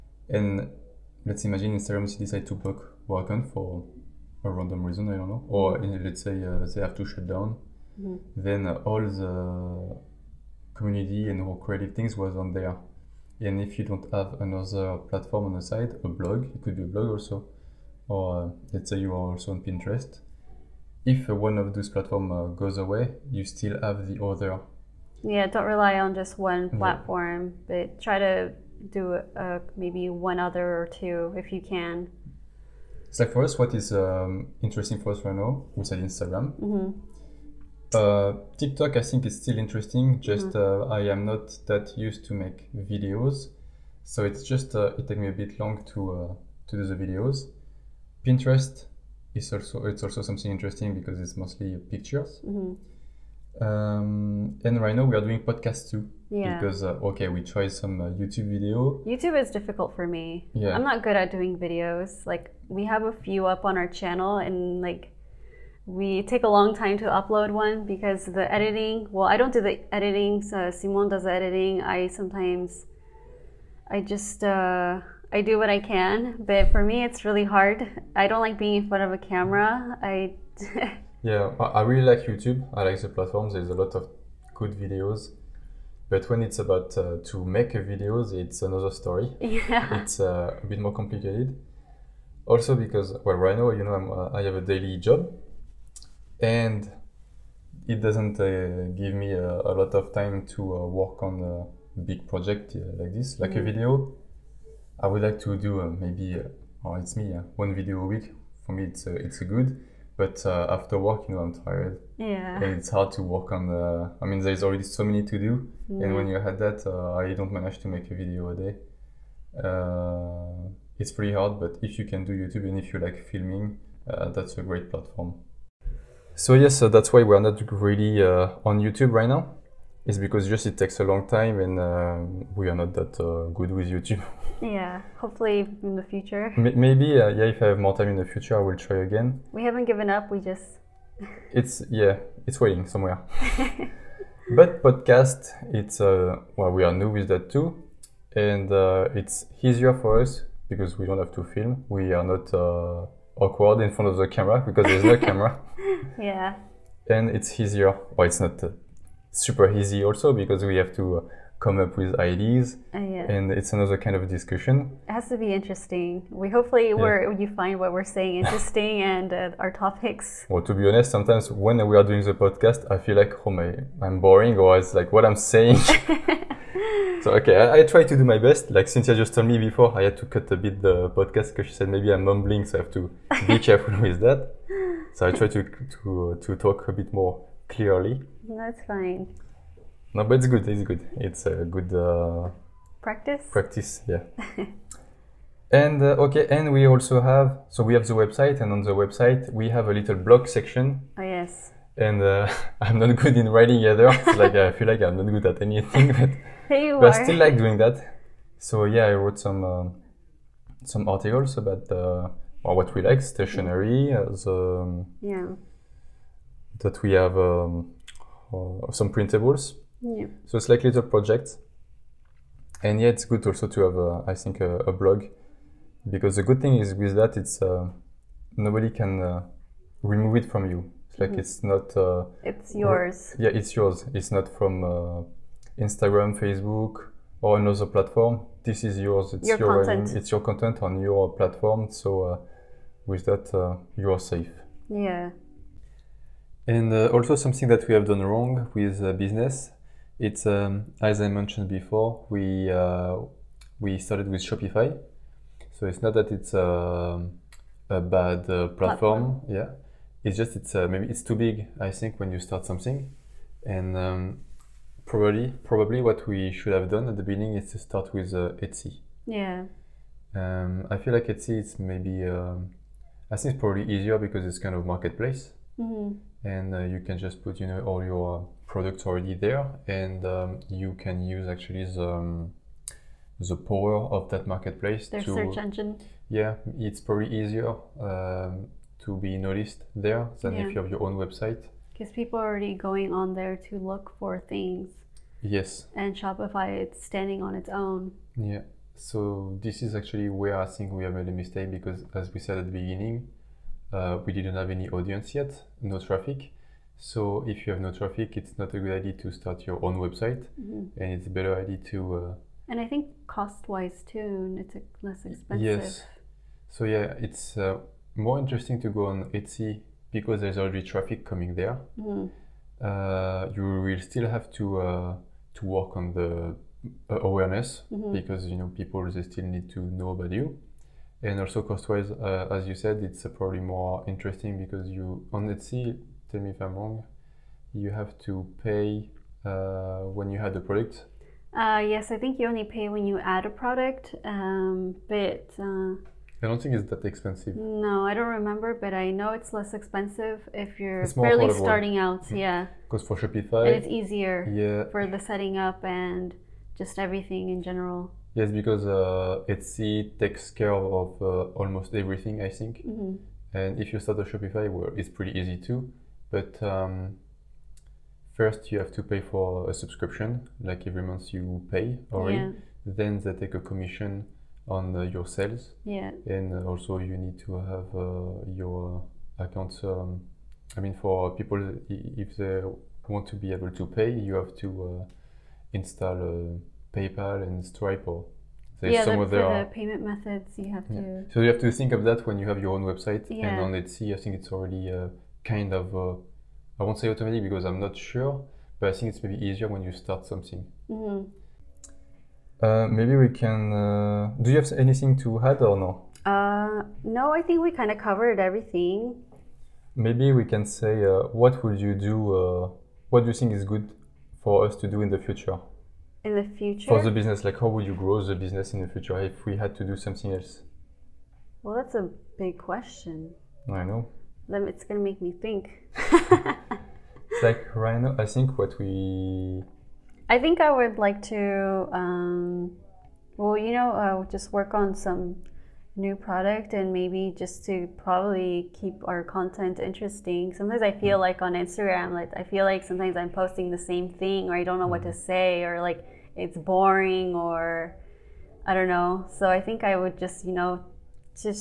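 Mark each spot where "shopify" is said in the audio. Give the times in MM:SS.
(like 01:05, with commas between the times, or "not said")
04:14, 04:56, 05:53, 06:04.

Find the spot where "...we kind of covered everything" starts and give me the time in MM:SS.
06:47.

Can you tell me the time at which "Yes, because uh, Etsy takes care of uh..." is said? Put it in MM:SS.
05:58.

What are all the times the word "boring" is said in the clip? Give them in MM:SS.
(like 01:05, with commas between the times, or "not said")
02:54, 07:26.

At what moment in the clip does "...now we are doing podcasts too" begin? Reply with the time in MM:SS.
00:54.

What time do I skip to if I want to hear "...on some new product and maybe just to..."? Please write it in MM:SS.
07:14.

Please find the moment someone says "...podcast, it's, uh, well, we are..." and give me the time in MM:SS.
02:24.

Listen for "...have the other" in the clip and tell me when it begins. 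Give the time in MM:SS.
00:23.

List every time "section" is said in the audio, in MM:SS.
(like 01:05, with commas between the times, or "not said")
03:20.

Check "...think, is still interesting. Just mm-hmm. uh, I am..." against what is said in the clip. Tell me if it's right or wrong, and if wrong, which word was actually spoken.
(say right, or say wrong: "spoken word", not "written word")
right.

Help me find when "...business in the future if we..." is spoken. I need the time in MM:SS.
06:58.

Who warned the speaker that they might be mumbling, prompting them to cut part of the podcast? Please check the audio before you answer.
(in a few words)
Cynthia.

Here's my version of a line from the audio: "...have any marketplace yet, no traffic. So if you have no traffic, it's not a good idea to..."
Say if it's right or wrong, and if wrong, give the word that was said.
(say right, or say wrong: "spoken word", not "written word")
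wrong: "audience", not "marketplace".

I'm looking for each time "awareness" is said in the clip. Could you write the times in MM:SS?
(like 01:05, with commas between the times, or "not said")
05:27.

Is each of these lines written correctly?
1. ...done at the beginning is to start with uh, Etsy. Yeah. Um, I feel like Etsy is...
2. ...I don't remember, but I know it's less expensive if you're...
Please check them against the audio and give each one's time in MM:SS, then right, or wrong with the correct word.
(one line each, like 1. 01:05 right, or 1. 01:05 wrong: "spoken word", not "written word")
1. 04:26 right
2. 05:48 right.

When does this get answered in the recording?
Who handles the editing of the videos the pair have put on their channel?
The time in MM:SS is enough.
01:10.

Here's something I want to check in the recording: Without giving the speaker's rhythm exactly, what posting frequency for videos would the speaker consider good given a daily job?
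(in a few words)
one video a week.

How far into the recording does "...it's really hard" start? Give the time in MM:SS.
01:17.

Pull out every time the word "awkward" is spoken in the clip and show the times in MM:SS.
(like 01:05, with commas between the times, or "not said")
02:33.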